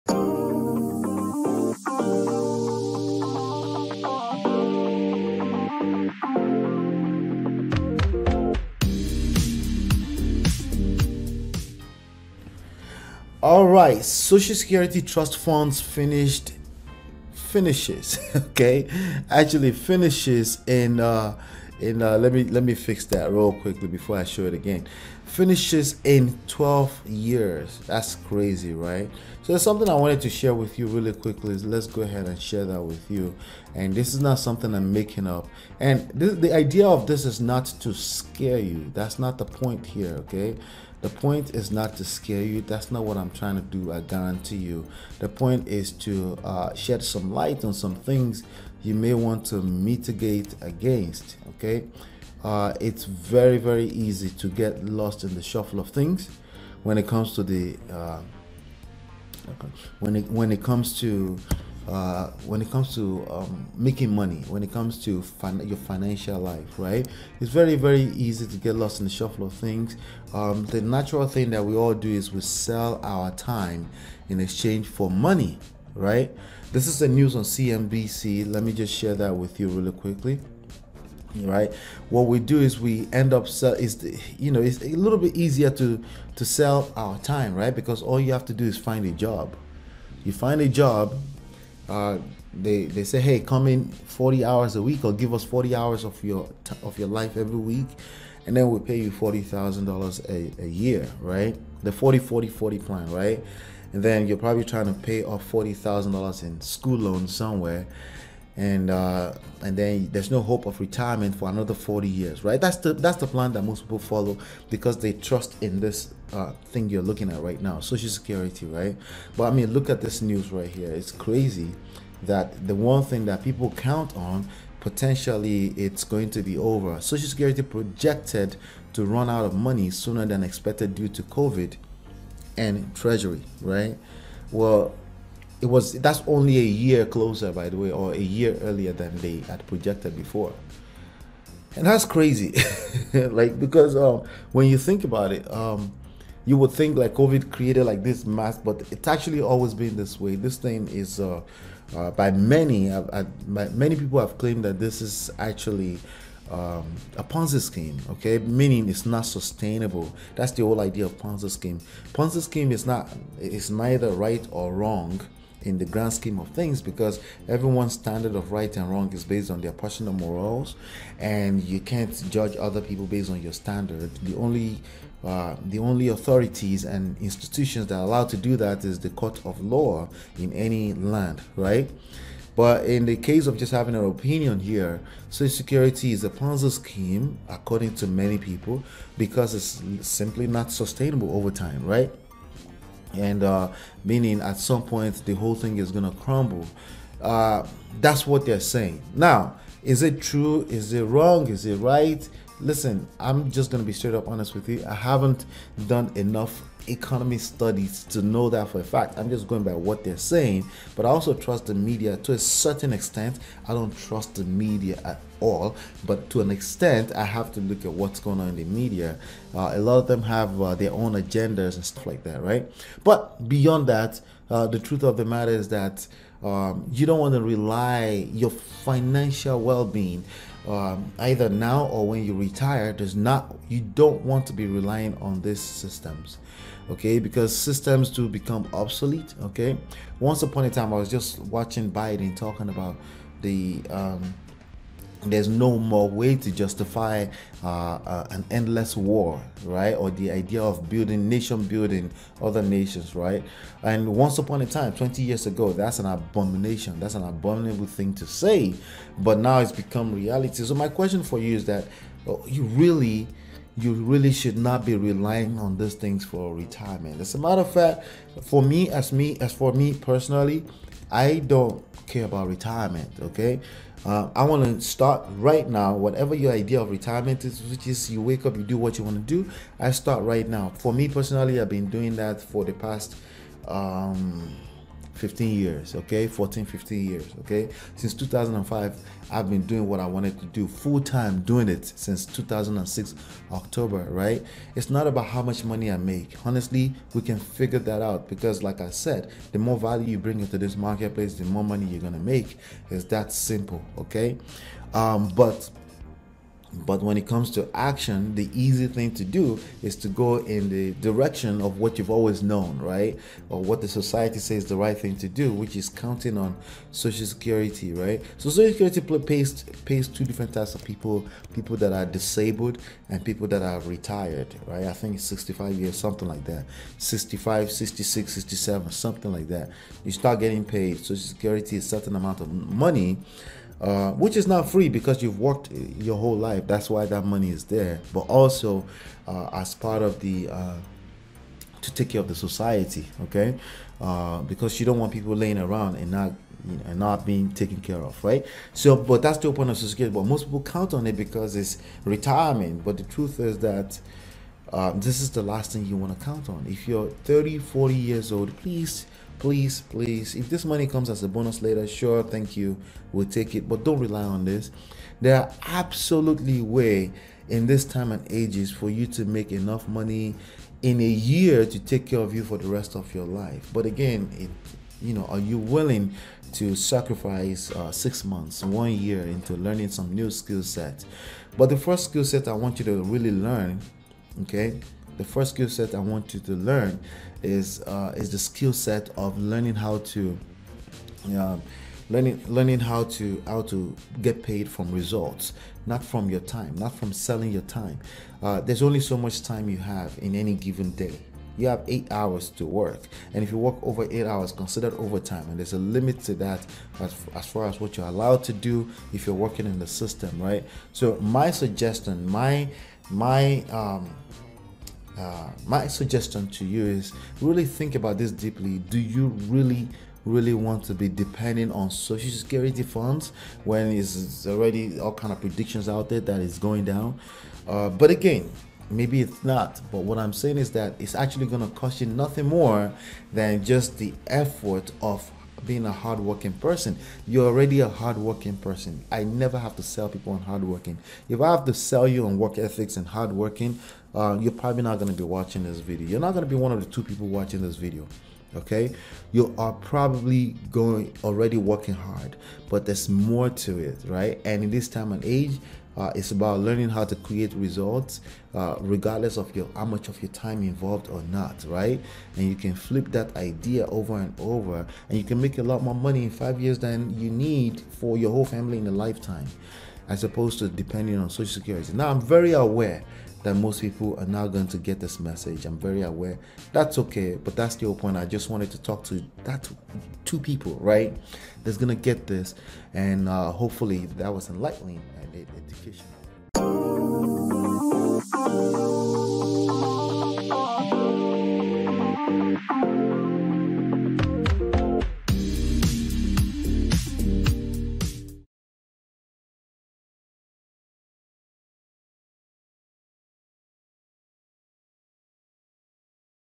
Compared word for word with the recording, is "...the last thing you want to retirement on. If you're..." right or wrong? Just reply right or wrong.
wrong.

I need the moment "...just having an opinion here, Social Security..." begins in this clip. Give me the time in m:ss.
3:03.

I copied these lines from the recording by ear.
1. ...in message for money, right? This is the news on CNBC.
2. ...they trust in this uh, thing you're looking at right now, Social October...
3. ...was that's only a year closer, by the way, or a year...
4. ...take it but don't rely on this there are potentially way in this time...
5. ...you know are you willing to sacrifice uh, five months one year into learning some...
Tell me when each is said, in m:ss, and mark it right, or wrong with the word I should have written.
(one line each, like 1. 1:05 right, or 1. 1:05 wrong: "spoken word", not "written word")
1. 1:14 wrong: "exchange", not "message"
2. 1:54 wrong: "Security", not "October"
3. 2:15 right
4. 6:03 wrong: "absolutely", not "potentially"
5. 6:15 wrong: "six", not "five".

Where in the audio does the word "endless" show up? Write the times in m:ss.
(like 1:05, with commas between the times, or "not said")
4:08.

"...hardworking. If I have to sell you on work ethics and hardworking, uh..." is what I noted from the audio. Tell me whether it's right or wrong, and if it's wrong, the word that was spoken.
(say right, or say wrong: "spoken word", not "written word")
right.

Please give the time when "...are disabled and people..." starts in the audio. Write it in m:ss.
5:21.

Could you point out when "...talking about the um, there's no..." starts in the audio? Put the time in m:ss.
4:02.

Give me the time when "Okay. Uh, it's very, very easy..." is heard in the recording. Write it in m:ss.
0:51.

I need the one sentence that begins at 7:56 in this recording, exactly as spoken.
That's okay, but that's the point.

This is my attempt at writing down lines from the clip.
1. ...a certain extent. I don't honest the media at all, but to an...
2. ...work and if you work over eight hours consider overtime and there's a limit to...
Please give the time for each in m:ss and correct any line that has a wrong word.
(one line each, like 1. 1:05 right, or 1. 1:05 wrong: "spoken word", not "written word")
1. 3:32 wrong: "trust", not "honest"
2. 6:42 right.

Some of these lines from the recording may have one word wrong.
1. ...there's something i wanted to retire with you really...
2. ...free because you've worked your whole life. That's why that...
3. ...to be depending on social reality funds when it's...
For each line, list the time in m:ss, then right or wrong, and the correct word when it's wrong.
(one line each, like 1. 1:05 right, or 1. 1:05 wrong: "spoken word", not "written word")
1. 0:29 wrong: "share", not "retire"
2. 5:34 right
3. 7:00 wrong: "security", not "reality".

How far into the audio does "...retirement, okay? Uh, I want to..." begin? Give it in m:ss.
4:32.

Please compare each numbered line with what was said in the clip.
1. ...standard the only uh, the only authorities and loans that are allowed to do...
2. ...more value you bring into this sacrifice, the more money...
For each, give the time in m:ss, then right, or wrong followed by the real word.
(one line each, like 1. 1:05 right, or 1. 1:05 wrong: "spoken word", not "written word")
1. 2:53 wrong: "institutions", not "loans"
2. 4:59 wrong: "marketplace", not "sacrifice".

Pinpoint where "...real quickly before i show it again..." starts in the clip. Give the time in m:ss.
0:23.